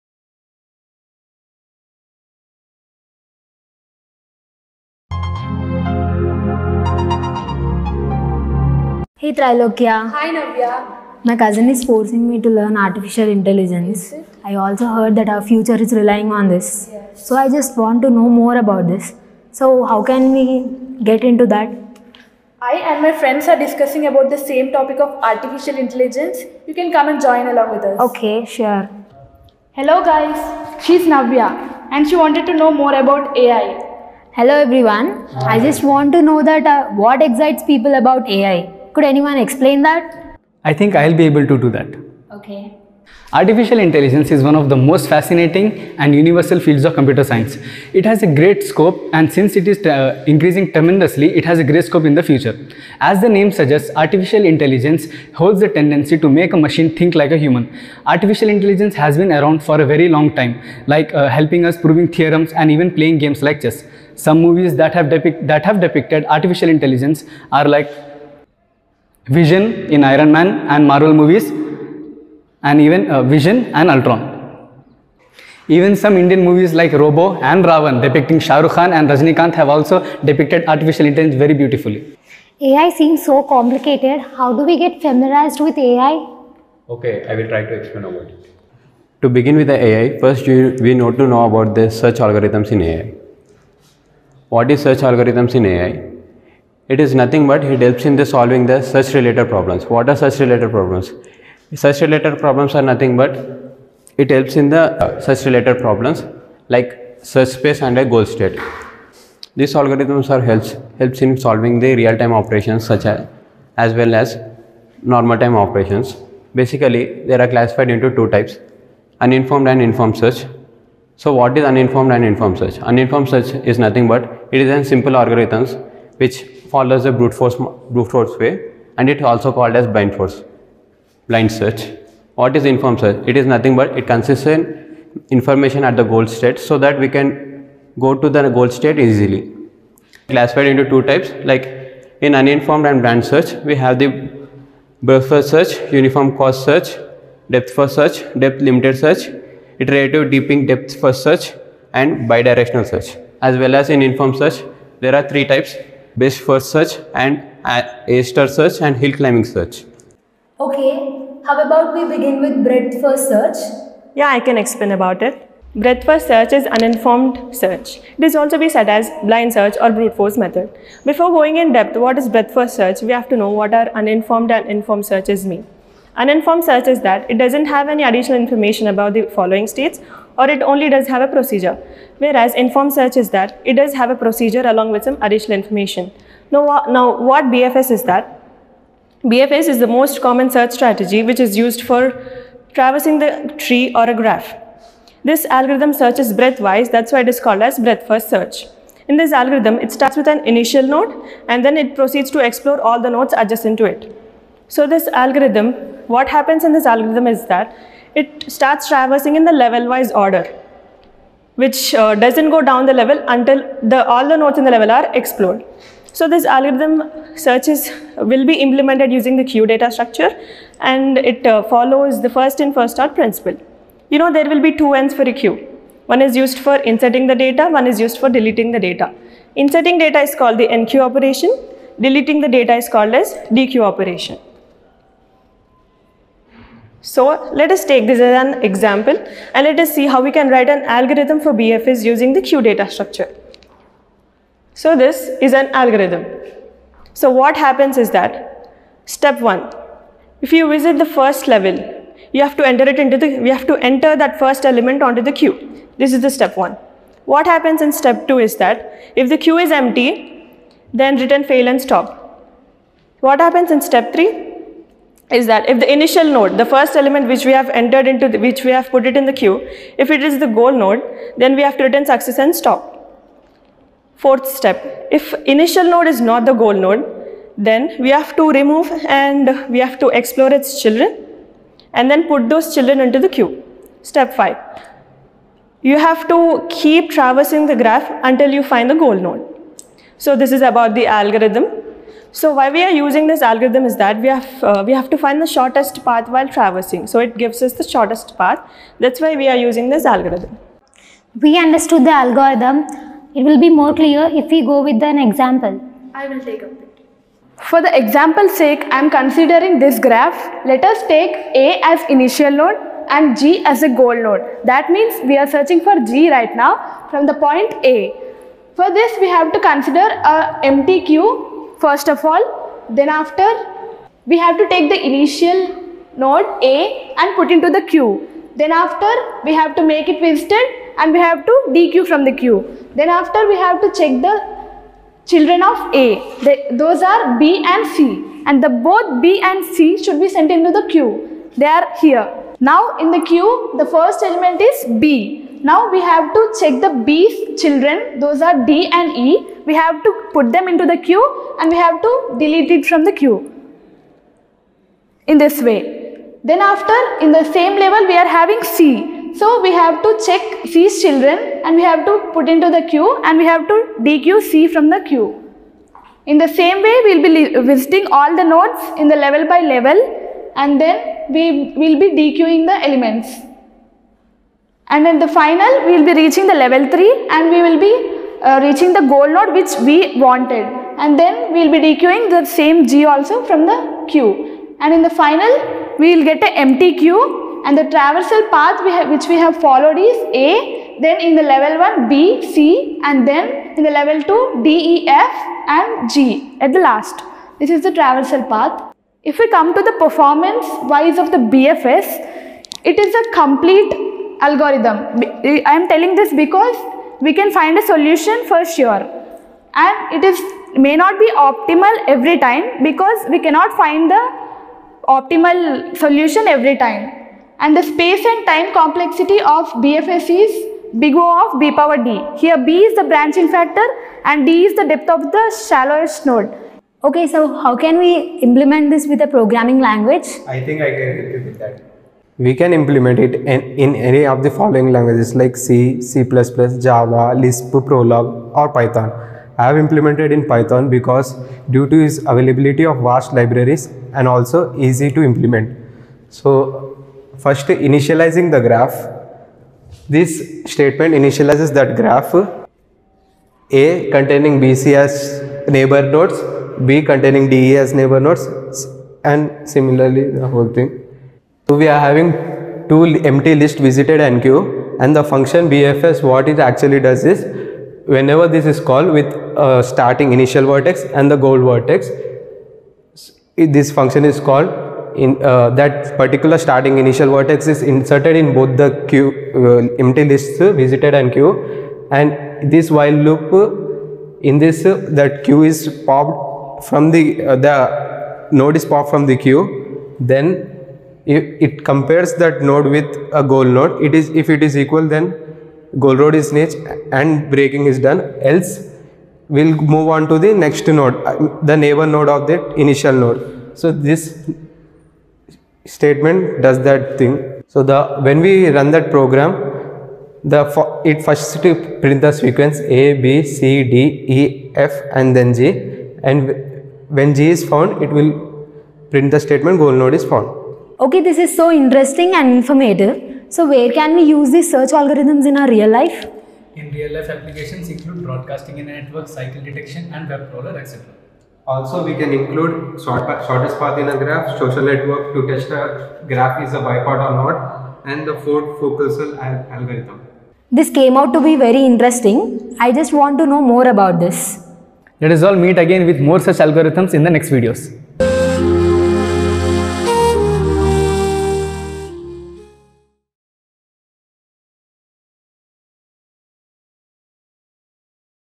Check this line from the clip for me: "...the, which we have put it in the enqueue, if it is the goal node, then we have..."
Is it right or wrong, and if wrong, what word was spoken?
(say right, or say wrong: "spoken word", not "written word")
wrong: "queue", not "enqueue".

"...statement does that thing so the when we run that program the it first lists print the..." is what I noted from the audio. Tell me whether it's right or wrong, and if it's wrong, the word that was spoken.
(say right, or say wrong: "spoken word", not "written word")
wrong: "prints", not "lists".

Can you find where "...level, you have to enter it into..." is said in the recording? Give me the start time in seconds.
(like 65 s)
251 s.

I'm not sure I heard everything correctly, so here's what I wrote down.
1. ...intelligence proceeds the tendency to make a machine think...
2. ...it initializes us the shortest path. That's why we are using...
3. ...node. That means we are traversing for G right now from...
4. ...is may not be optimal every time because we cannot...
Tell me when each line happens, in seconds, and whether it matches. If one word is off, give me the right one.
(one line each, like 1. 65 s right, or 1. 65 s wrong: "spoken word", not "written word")
1. 54 s wrong: "holds", not "proceeds"
2. 297 s wrong: "gives", not "initializes"
3. 314 s wrong: "searching", not "traversing"
4. 410 s right.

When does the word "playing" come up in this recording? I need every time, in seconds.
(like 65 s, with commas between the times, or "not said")
62 s.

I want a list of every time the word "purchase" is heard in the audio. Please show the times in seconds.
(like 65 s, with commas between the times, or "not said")
not said.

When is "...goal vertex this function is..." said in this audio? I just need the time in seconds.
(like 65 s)
471 s.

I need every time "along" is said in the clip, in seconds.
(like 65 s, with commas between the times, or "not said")
27 s, 184 s.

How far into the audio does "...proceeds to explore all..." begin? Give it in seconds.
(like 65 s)
201 s.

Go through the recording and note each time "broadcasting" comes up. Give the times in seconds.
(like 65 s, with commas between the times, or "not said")
528 s.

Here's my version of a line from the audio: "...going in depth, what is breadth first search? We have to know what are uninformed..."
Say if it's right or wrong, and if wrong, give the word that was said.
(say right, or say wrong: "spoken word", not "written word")
right.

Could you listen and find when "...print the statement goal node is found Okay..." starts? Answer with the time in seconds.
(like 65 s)
519 s.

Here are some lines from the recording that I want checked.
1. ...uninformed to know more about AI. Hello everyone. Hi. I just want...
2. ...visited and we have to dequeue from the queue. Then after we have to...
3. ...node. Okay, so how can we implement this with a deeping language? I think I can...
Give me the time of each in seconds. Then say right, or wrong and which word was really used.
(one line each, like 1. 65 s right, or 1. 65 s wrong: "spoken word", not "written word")
1. 32 s wrong: "wanted", not "uninformed"
2. 330 s right
3. 426 s wrong: "programming", not "deeping".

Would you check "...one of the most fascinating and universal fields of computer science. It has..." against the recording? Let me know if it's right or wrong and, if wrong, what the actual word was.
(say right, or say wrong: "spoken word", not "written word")
right.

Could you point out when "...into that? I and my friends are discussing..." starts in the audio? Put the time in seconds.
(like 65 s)
21 s.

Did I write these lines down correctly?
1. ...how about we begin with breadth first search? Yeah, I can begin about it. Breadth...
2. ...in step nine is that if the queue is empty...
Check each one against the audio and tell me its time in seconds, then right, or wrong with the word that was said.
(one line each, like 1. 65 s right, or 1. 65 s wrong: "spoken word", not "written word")
1. 161 s wrong: "explain", not "begin"
2. 257 s wrong: "two", not "nine".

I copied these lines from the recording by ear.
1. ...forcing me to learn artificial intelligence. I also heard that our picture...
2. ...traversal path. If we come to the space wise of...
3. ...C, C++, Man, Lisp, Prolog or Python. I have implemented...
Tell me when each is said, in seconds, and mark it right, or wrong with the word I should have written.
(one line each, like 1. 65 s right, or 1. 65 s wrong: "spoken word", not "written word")
1. 11 s wrong: "future", not "picture"
2. 397 s wrong: "performance", not "space"
3. 435 s wrong: "Java", not "Man".